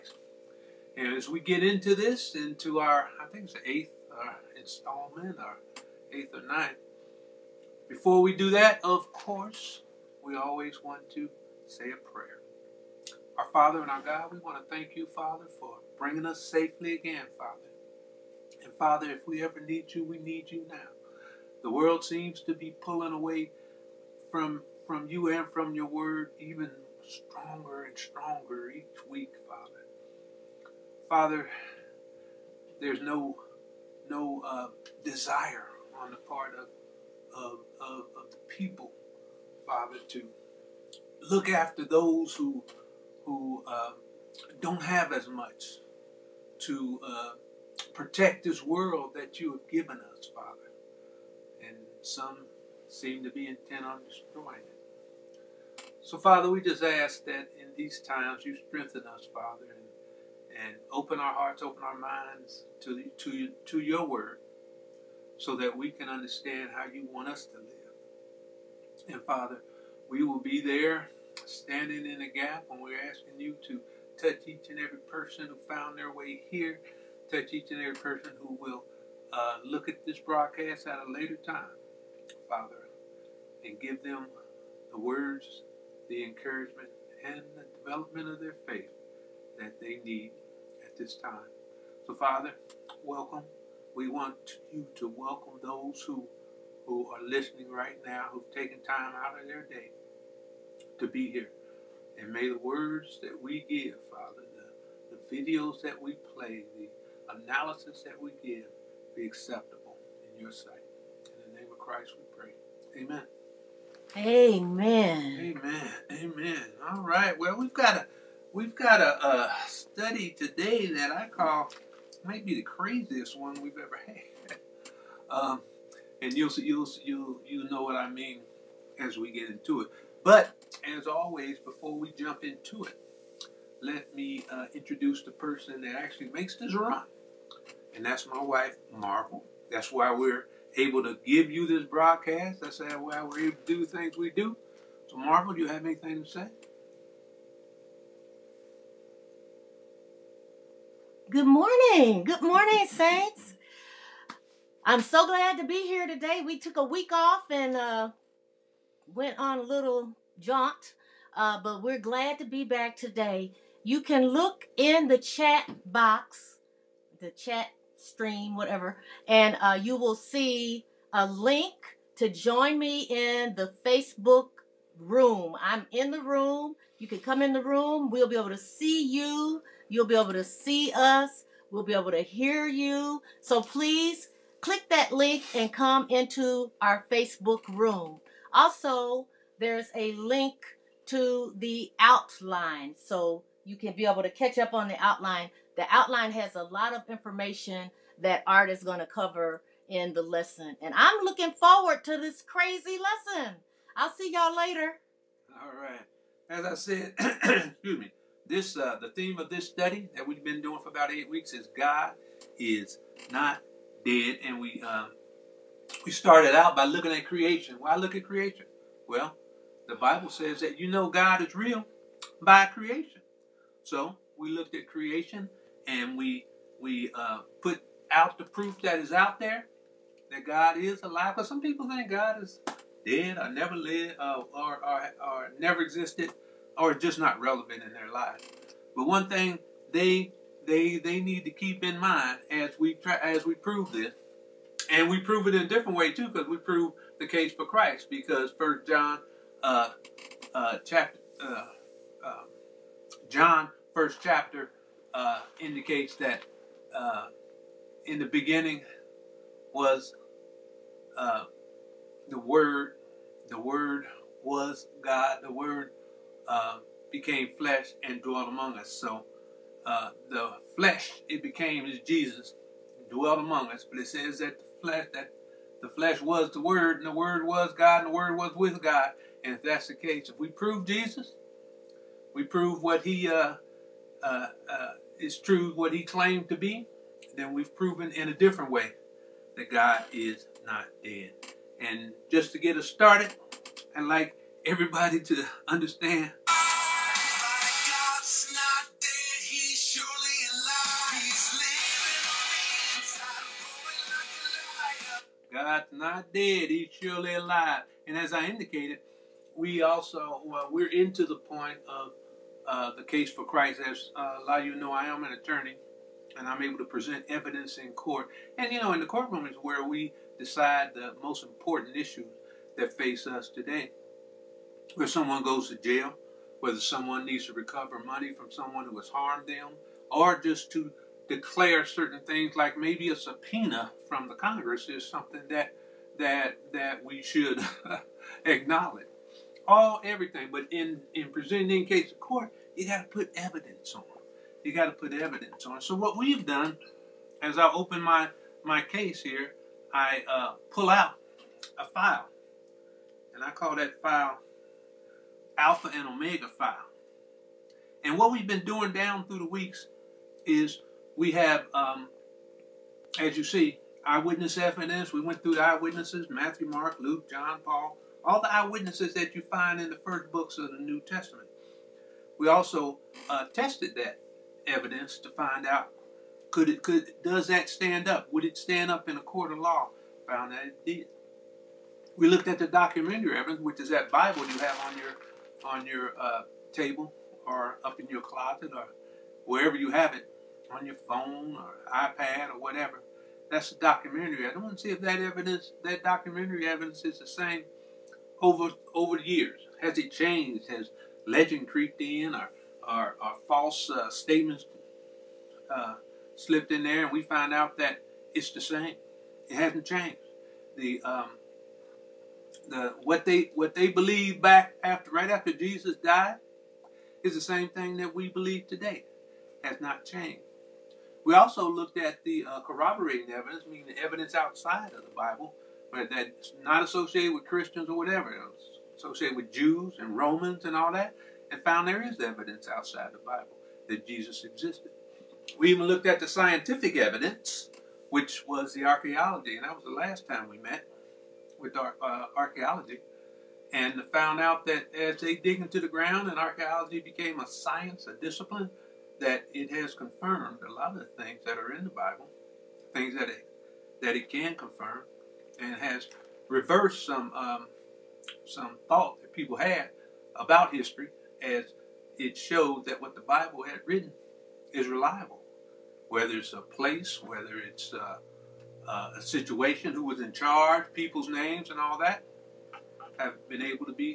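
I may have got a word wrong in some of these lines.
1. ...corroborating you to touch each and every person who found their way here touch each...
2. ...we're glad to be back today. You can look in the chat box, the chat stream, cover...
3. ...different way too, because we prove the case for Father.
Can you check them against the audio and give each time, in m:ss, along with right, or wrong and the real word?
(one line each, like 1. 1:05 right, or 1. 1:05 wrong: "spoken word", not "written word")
1. 1:12 wrong: "asking", not "corroborating"
2. 2:41 wrong: "whatever", not "cover"
3. 4:05 wrong: "Christ", not "Father".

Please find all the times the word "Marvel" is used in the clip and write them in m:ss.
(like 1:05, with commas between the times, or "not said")
2:18, 2:25.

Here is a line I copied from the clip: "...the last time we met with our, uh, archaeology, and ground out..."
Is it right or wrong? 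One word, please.
wrong.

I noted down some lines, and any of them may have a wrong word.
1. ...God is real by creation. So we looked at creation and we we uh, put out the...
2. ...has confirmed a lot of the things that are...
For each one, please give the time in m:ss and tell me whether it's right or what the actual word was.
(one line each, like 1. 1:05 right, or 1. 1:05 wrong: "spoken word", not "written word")
1. 3:41 right
2. 7:29 right.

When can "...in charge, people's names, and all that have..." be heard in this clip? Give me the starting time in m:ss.
7:50.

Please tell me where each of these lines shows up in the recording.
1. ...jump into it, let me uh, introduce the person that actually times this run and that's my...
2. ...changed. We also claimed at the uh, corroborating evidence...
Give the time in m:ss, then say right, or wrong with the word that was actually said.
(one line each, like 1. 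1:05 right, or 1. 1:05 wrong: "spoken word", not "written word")
1. 2:12 wrong: "makes", not "times"
2. 7:00 wrong: "looked", not "claimed".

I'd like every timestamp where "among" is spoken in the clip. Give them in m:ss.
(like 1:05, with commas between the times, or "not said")
4:28, 4:33.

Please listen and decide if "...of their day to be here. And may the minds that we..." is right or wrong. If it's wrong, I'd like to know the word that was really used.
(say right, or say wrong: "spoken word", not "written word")
wrong: "words", not "minds".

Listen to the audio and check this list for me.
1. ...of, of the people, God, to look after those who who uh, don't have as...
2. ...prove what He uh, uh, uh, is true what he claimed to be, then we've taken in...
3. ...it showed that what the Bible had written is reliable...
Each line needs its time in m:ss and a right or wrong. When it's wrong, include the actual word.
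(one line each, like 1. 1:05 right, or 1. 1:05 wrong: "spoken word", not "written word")
1. 0:37 wrong: "Father", not "God"
2. 4:42 wrong: "proven", not "taken"
3. 7:42 right.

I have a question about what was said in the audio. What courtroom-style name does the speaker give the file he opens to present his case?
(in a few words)
Alpha and Omega file.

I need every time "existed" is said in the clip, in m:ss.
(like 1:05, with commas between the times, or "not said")
3:55, 7:14.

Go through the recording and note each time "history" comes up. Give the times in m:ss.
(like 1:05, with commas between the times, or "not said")
7:40.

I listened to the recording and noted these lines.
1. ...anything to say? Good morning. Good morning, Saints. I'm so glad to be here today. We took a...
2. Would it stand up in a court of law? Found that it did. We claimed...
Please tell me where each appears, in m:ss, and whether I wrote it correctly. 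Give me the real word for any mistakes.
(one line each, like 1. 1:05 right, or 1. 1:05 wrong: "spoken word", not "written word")
1. 2:25 right
2. 6:18 wrong: "looked", not "claimed".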